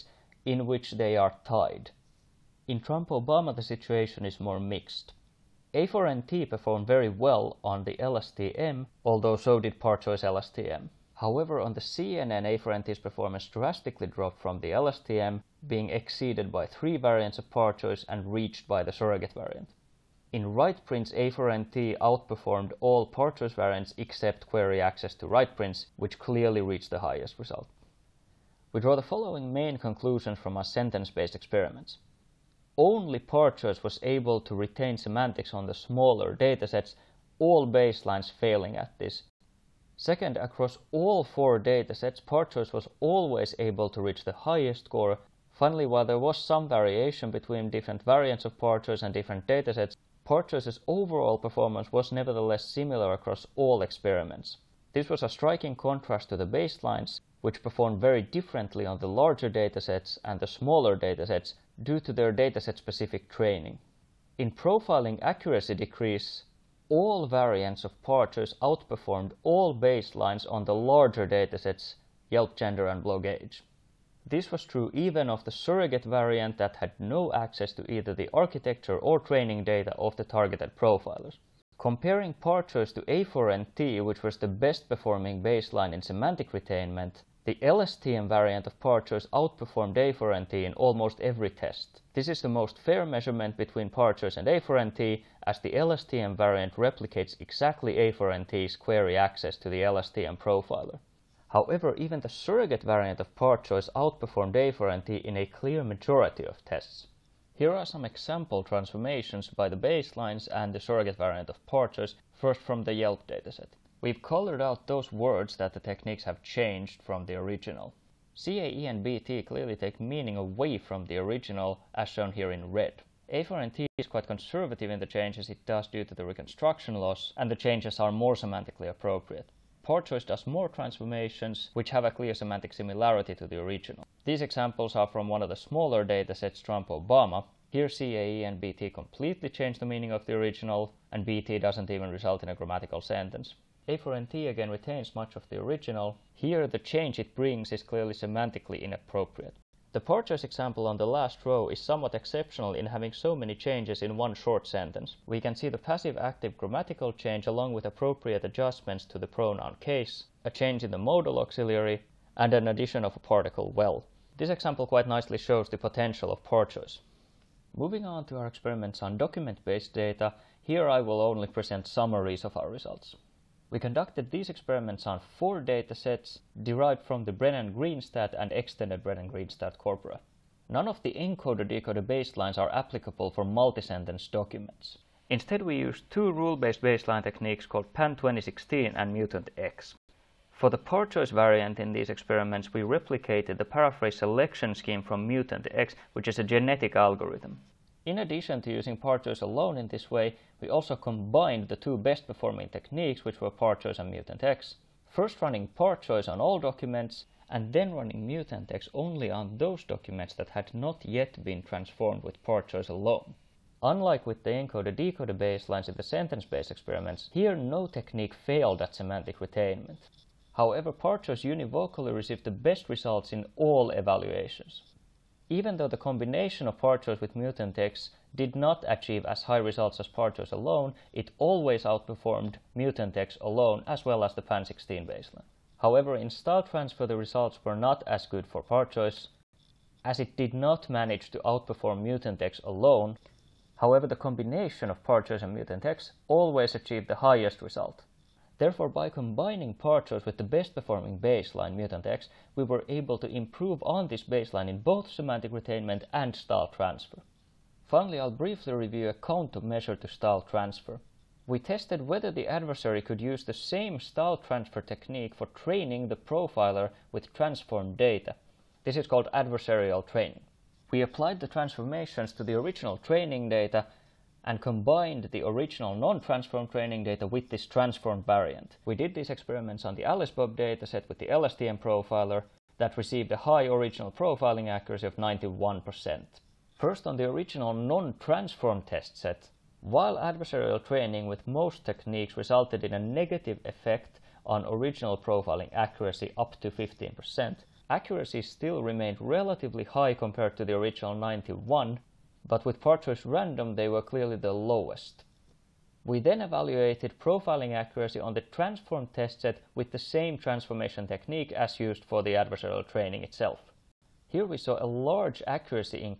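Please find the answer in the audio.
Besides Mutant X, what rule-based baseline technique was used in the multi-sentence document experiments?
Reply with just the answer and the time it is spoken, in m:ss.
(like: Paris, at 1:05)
PAN2016, at 3:07.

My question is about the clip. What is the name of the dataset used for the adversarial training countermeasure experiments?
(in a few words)
AliceBob.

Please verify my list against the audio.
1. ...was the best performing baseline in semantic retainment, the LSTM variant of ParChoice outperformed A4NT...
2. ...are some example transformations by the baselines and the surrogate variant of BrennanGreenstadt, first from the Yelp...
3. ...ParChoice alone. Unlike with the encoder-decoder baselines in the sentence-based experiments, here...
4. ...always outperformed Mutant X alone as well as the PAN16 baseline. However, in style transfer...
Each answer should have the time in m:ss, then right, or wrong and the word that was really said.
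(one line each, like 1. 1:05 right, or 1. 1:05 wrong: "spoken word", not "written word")
1. 1:24 right
2. 1:47 wrong: "ParChoice", not "BrennanGreenstadt"
3. 3:32 right
4. 3:51 right.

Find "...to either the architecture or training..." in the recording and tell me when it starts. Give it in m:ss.
1:17.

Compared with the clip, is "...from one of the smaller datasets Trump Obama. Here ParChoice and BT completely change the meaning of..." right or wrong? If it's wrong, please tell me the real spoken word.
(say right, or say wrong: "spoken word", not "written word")
wrong: "CAE", not "ParChoice".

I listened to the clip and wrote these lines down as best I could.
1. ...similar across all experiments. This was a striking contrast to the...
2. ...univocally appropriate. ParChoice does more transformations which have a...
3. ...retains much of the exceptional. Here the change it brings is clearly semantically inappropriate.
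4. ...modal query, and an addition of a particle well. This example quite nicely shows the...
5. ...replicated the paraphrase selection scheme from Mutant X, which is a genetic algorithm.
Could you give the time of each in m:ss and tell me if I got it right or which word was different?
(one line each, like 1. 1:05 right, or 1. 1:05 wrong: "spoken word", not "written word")
1. 0:52 right
2. 2:08 wrong: "semantically", not "univocally"
3. 2:24 wrong: "original", not "exceptional"
4. 2:40 wrong: "auxiliary", not "query"
5. 3:12 right.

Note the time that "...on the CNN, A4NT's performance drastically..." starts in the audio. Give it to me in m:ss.
0:11.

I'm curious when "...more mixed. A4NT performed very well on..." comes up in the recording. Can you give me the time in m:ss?
0:04.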